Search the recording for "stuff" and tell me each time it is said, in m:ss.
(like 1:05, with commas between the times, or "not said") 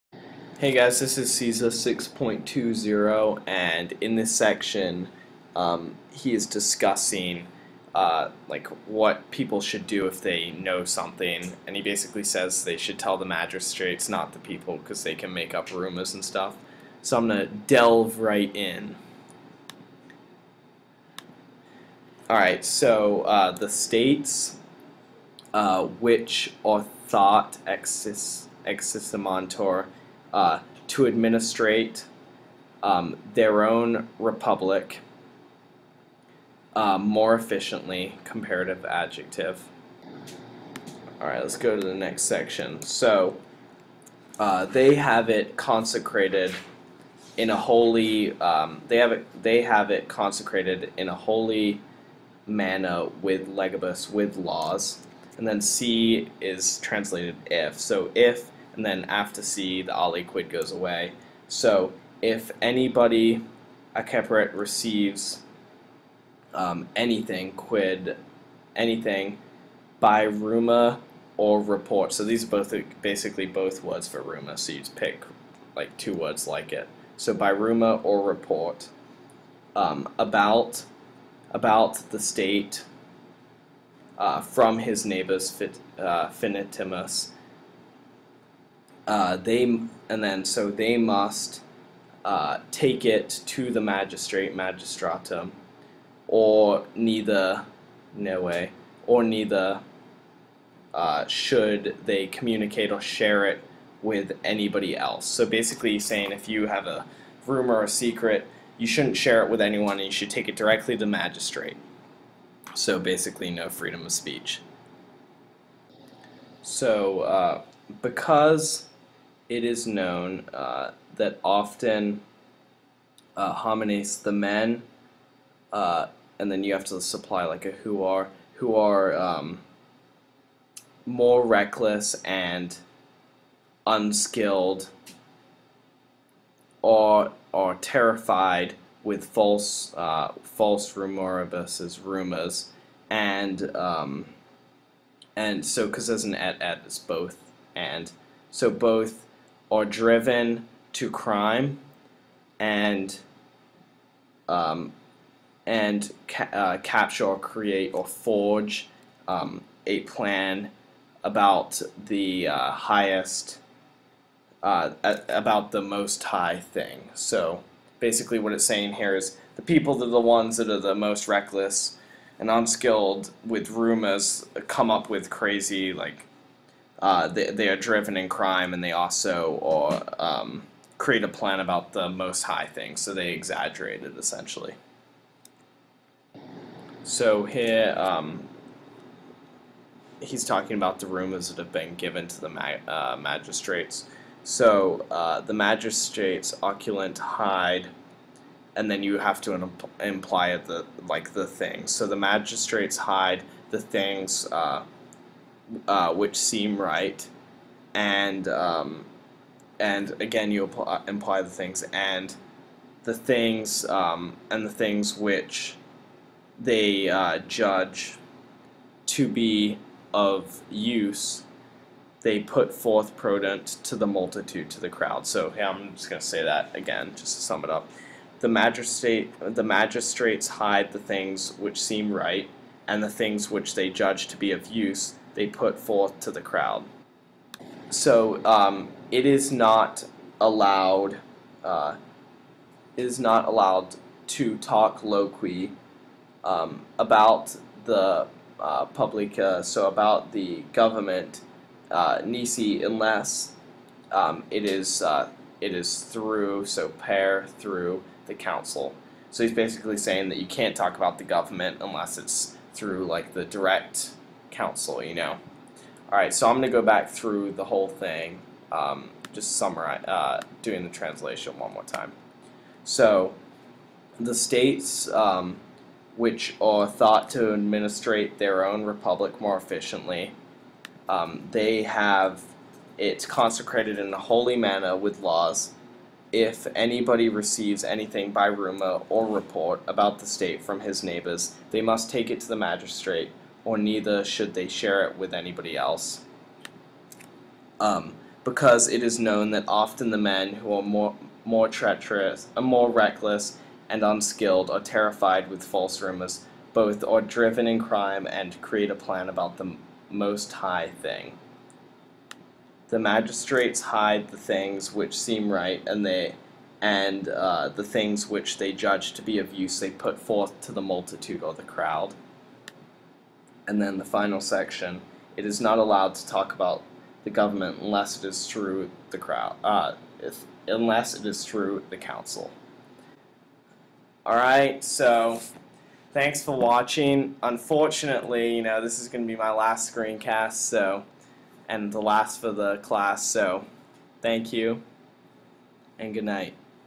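0:16.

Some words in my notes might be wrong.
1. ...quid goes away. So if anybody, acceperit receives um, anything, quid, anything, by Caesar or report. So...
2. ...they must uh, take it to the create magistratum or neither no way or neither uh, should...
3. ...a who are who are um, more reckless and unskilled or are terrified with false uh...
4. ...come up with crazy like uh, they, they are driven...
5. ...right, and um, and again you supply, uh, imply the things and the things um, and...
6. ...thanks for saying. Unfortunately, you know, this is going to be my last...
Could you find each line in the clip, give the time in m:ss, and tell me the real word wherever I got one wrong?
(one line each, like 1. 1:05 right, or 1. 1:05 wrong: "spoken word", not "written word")
1. 1:00 wrong: "Ruma", not "Caesar"
2. 1:30 wrong: "magistrate", not "create"
3. 2:07 right
4. 2:54 right
5. 3:26 wrong: "apply", not "supply"
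6. 5:36 wrong: "watching", not "saying".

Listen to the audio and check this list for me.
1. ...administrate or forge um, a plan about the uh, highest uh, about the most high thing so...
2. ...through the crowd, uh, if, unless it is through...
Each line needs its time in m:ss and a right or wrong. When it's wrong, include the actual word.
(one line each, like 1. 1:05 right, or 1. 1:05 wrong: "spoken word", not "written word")
1. 2:37 wrong: "create", not "administrate"
2. 5:28 right.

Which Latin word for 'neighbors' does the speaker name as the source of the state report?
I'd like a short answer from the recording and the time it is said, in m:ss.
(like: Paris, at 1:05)
Finitimus, at 1:26.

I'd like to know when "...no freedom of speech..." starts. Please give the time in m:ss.
1:53.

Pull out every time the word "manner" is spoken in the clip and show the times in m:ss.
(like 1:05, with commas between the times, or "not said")
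0:52, 4:44.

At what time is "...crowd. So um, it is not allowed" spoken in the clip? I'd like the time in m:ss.
3:56.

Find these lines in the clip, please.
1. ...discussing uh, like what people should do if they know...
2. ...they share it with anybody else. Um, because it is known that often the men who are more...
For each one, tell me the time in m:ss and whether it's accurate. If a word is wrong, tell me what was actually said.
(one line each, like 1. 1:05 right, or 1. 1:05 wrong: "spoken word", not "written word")
1. 0:06 right
2. 4:54 right.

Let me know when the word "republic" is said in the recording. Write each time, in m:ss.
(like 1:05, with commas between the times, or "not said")
0:34, 4:38.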